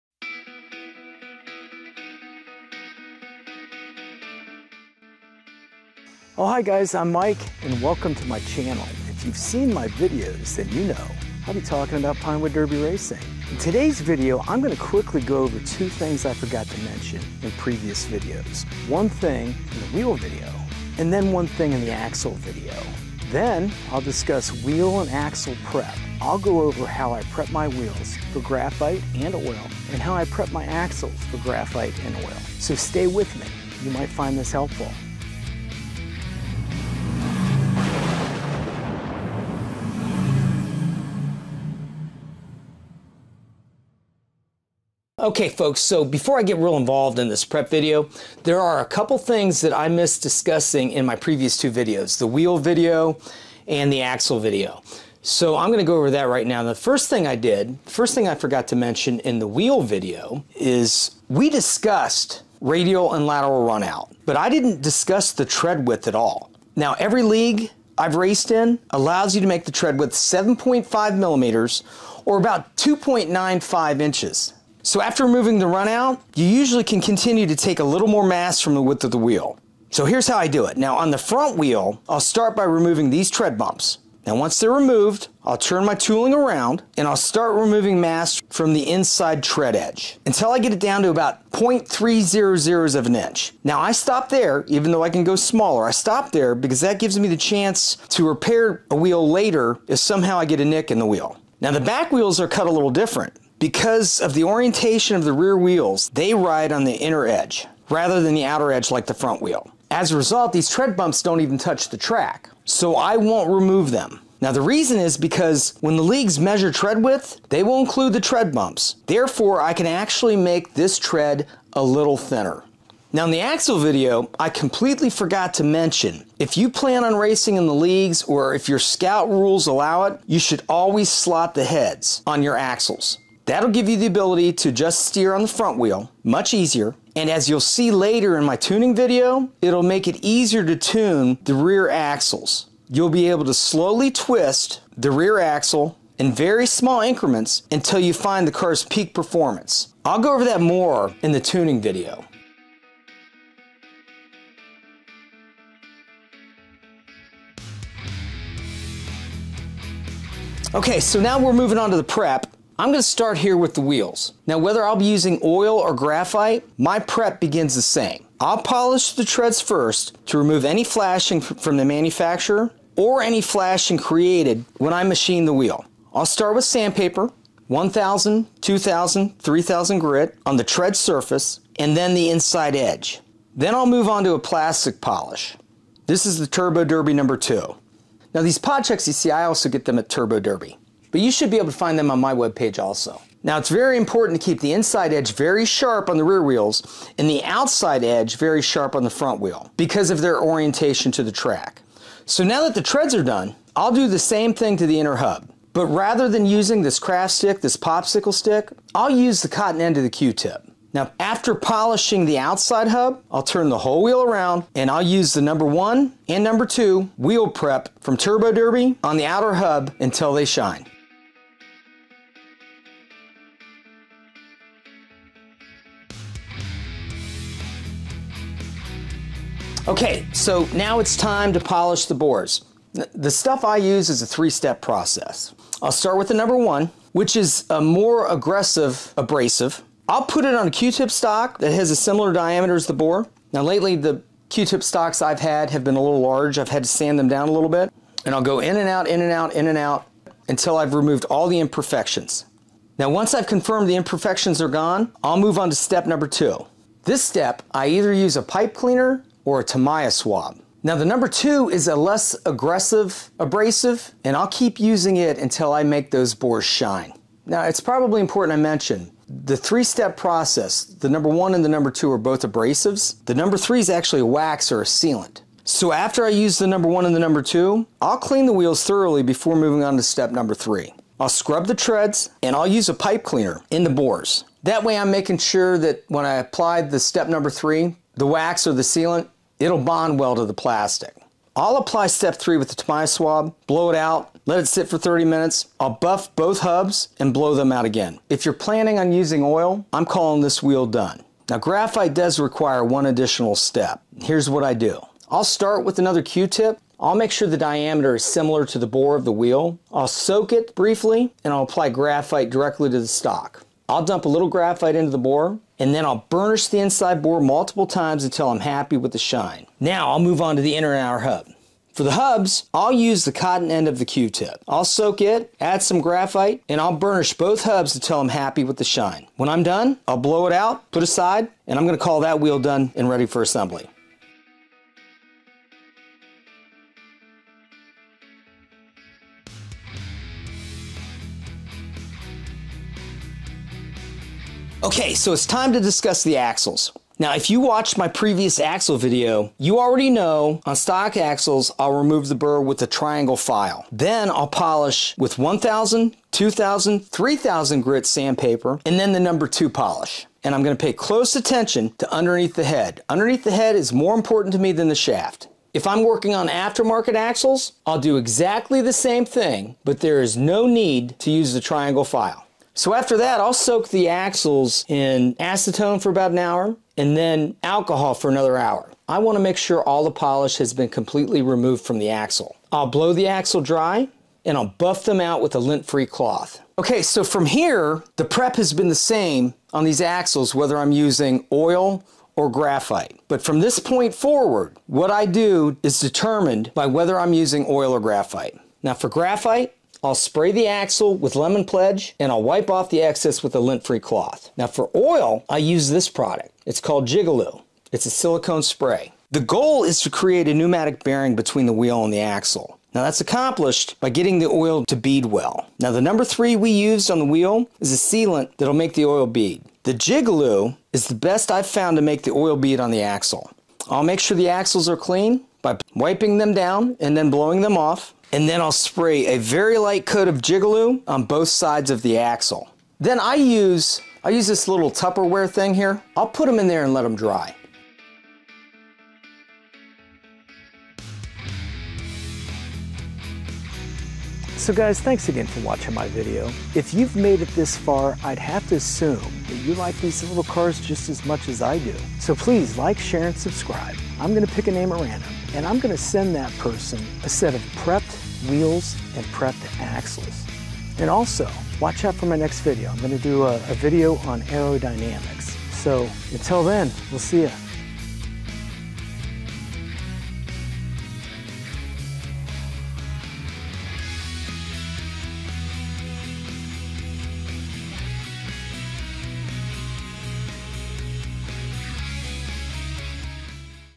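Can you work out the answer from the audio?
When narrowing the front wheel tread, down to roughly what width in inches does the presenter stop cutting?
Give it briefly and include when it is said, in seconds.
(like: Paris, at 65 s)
0.300 of an inch, at 91 s.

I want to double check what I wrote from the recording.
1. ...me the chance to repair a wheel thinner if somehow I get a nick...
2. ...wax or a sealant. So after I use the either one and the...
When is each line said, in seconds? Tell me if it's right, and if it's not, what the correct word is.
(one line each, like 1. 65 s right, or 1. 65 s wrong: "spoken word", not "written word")
1. 97 s wrong: "later", not "thinner"
2. 274 s wrong: "number", not "either".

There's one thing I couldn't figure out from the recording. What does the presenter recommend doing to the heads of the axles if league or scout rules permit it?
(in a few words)
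slot the heads.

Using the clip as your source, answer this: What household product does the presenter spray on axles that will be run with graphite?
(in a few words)
Lemon Pledge.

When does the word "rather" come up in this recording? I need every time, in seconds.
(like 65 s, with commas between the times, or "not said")
107 s, 205 s.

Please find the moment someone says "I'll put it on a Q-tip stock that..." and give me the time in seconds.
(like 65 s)
240 s.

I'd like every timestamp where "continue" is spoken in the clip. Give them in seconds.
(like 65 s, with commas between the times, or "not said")
77 s.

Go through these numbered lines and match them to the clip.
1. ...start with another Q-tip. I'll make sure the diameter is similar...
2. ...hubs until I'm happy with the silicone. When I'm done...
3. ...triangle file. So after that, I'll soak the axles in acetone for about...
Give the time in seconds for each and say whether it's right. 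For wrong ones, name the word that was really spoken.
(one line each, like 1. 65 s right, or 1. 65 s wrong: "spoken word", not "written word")
1. 305 s right
2. 327 s wrong: "shine", not "silicone"
3. 371 s right.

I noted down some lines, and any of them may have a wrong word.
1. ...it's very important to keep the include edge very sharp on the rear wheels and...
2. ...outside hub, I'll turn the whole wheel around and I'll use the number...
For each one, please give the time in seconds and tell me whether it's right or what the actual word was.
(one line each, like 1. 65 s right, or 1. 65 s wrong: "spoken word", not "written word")
1. 193 s wrong: "inside", not "include"
2. 212 s right.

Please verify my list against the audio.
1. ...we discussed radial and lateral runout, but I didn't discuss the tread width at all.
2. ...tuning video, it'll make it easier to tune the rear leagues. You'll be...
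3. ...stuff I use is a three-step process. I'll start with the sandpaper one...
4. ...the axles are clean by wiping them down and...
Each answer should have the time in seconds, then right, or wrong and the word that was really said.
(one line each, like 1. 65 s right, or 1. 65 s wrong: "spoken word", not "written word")
1. 61 s right
2. 138 s wrong: "axles", not "leagues"
3. 233 s wrong: "number", not "sandpaper"
4. 424 s right.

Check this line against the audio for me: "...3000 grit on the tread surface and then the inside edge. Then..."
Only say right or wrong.
right.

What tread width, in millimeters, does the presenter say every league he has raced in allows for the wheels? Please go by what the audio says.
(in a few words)
7.5 millimeters.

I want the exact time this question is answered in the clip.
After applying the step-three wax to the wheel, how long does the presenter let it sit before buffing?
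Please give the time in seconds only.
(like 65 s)
294 s.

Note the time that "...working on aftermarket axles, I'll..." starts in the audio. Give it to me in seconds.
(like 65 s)
366 s.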